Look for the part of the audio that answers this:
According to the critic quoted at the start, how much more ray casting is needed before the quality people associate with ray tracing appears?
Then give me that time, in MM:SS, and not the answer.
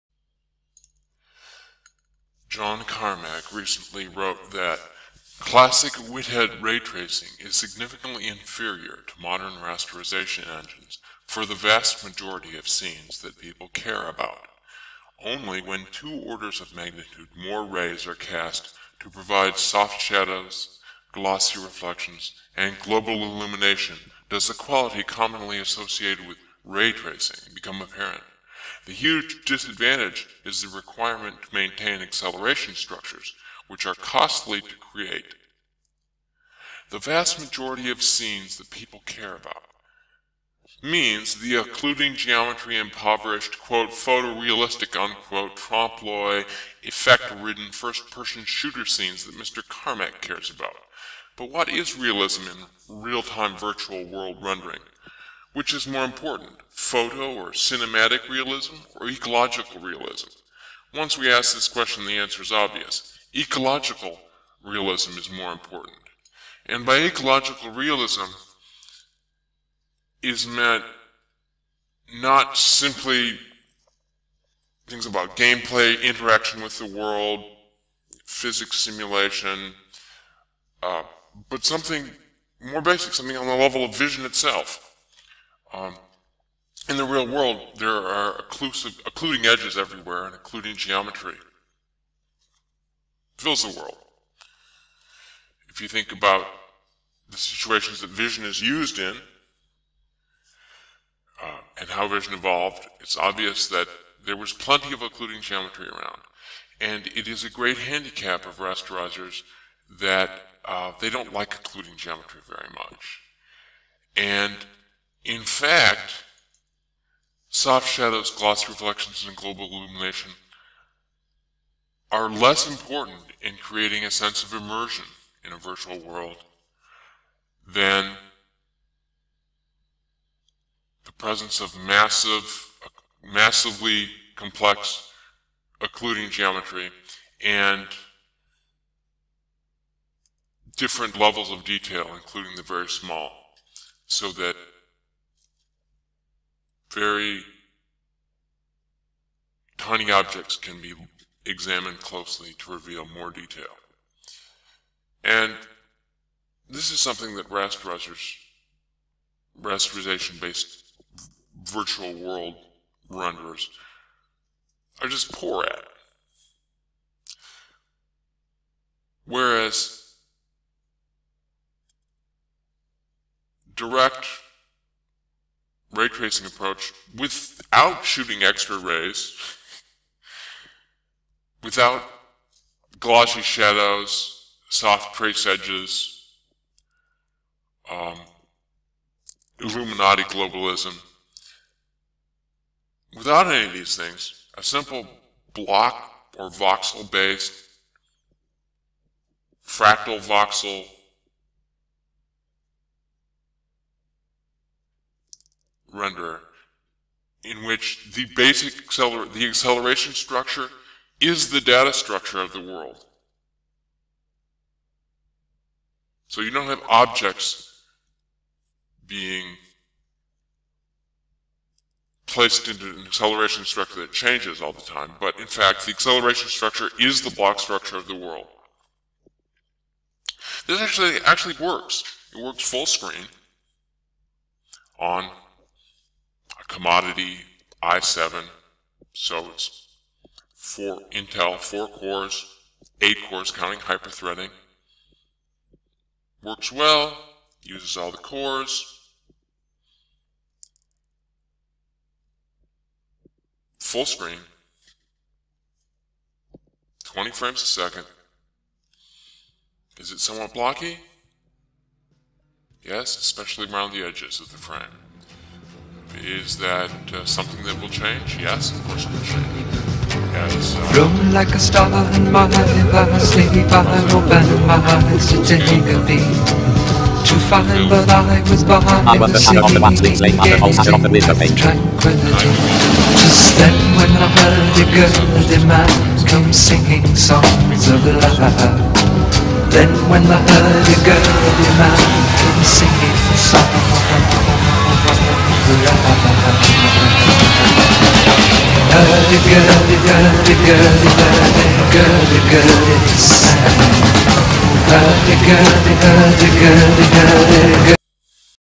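00:15.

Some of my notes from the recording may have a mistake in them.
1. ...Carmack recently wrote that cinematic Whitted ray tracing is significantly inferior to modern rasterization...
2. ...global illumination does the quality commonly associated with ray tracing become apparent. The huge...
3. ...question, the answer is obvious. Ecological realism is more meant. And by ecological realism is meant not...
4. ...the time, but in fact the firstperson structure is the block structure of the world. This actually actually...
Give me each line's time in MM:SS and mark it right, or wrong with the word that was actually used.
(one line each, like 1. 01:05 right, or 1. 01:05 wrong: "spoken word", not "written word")
1. 00:02 wrong: "classic", not "cinematic"
2. 00:22 right
3. 01:01 wrong: "important", not "meant"
4. 03:44 wrong: "acceleration", not "firstperson".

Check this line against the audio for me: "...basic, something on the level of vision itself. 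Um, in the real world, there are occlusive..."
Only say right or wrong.
right.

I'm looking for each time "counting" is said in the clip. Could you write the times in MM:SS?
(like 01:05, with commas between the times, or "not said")
04:03.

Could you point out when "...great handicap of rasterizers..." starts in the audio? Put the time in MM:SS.
01:47.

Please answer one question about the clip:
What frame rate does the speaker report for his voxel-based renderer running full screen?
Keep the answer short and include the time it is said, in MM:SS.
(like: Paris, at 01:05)
20 frames a second, at 04:17.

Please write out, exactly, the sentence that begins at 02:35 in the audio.
And this is something that rasterizers, rasterization-based virtual world renderers are just poor at.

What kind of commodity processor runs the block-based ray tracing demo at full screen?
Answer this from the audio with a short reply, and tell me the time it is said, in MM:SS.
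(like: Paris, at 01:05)
i7, at 03:57.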